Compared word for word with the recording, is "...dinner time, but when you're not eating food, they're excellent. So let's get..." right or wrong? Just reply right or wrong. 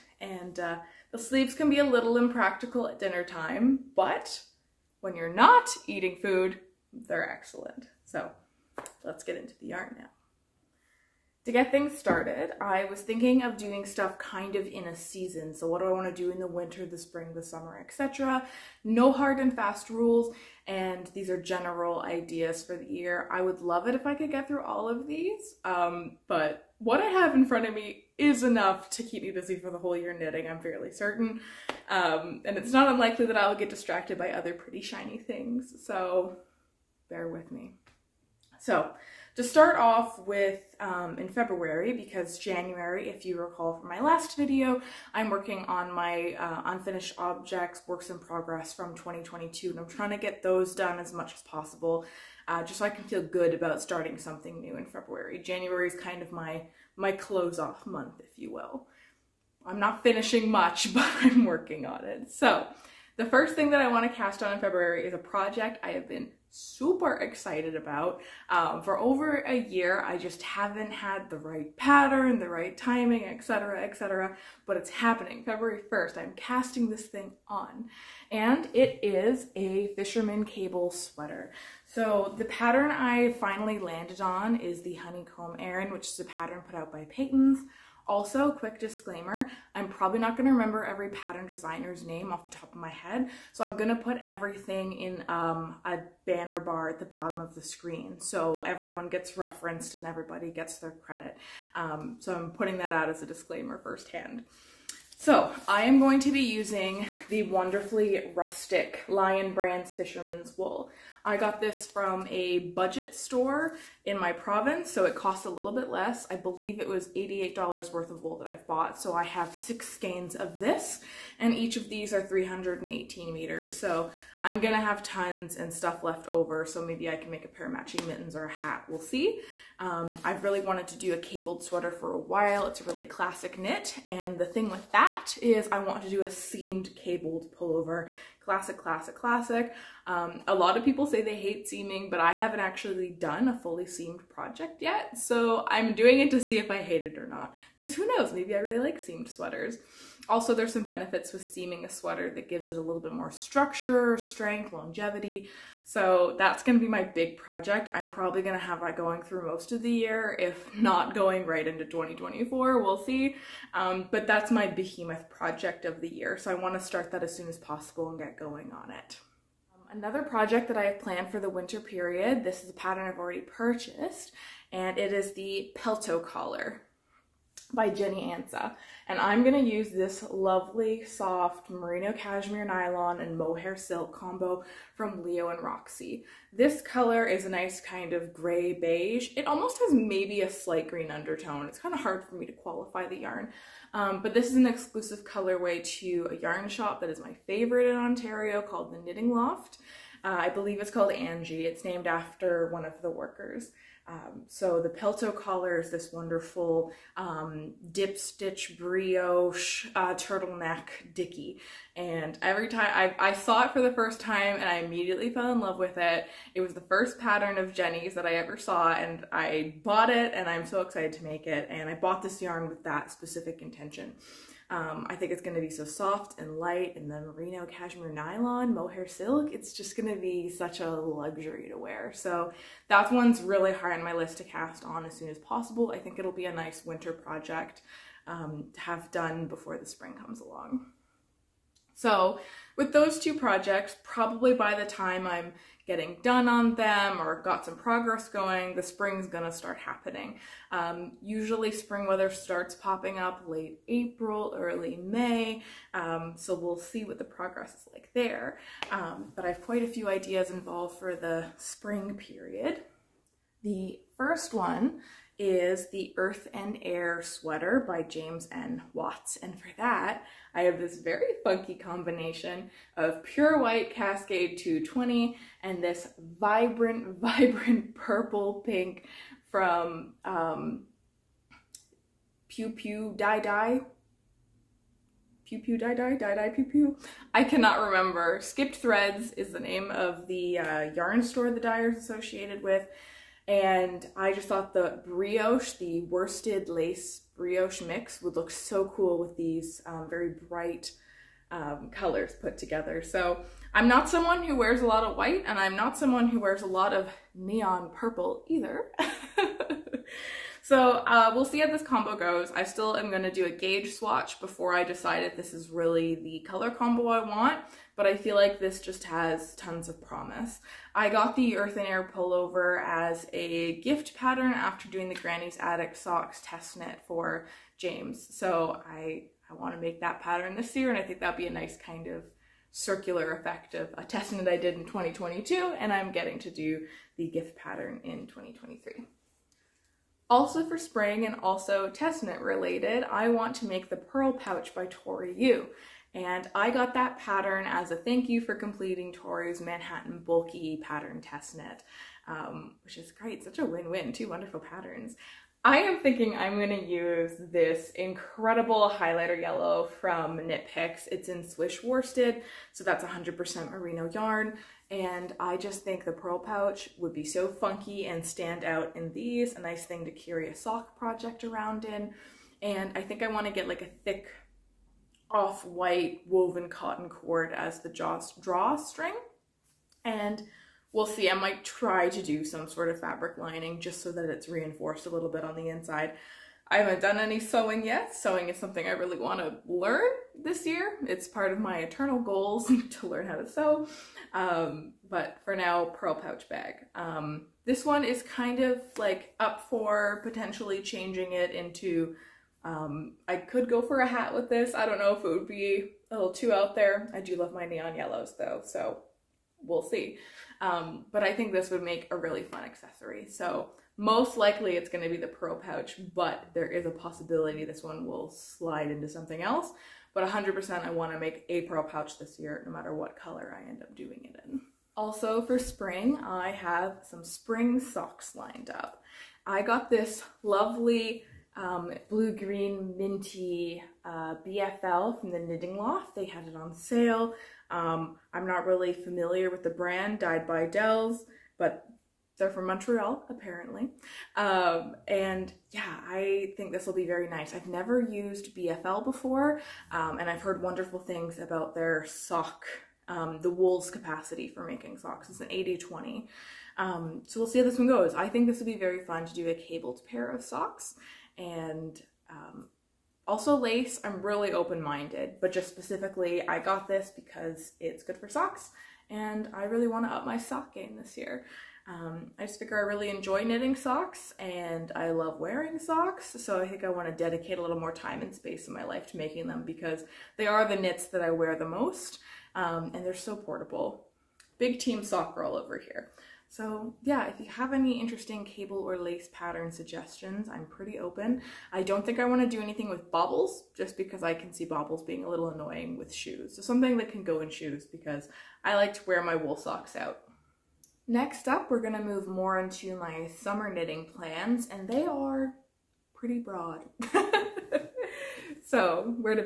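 right.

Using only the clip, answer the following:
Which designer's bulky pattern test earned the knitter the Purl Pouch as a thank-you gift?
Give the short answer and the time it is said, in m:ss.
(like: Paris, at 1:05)
Tori Yu, at 5:44.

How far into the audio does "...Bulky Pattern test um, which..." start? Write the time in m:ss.
5:50.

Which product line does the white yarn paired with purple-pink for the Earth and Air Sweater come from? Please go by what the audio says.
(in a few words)
Cascade 220.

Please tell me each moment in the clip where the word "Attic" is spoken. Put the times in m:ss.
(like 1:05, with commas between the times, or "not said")
5:25.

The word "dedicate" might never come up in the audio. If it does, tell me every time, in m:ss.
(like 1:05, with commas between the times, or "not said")
7:57.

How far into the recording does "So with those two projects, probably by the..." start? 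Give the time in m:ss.
4:01.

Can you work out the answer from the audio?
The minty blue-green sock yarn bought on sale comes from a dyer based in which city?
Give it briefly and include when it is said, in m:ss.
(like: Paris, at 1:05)
Montreal, at 7:22.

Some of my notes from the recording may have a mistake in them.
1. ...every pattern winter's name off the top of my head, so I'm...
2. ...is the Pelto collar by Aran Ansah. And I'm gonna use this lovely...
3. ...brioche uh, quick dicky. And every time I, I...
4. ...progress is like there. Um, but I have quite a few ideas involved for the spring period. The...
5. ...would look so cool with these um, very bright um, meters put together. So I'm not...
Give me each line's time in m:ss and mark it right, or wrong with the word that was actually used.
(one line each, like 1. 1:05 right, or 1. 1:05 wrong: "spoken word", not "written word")
1. 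1:30 wrong: "designer", not "winter"
2. 2:55 wrong: "Jenny", not "Aran"
3. 3:28 wrong: "turtleneck", not "quick"
4. 4:17 right
5. 4:58 wrong: "colors", not "meters".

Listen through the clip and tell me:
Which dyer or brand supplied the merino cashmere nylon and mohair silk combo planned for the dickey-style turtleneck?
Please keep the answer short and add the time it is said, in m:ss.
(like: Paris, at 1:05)
Leo and Roxy, at 3:05.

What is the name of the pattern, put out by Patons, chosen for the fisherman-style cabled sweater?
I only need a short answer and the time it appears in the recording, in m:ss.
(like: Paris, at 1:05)
Honeycomb Aran, at 1:24.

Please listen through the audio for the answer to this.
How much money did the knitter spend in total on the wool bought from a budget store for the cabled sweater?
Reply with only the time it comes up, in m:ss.
1:57.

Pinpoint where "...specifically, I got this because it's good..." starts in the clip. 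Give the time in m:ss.
7:45.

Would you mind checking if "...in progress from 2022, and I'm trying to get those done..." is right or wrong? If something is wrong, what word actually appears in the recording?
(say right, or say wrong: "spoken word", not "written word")
right.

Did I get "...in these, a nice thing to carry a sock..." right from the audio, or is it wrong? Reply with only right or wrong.
right.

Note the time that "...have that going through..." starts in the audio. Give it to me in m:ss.
2:38.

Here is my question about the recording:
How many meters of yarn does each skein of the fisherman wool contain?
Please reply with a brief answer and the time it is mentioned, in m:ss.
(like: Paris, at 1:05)
318, at 2:02.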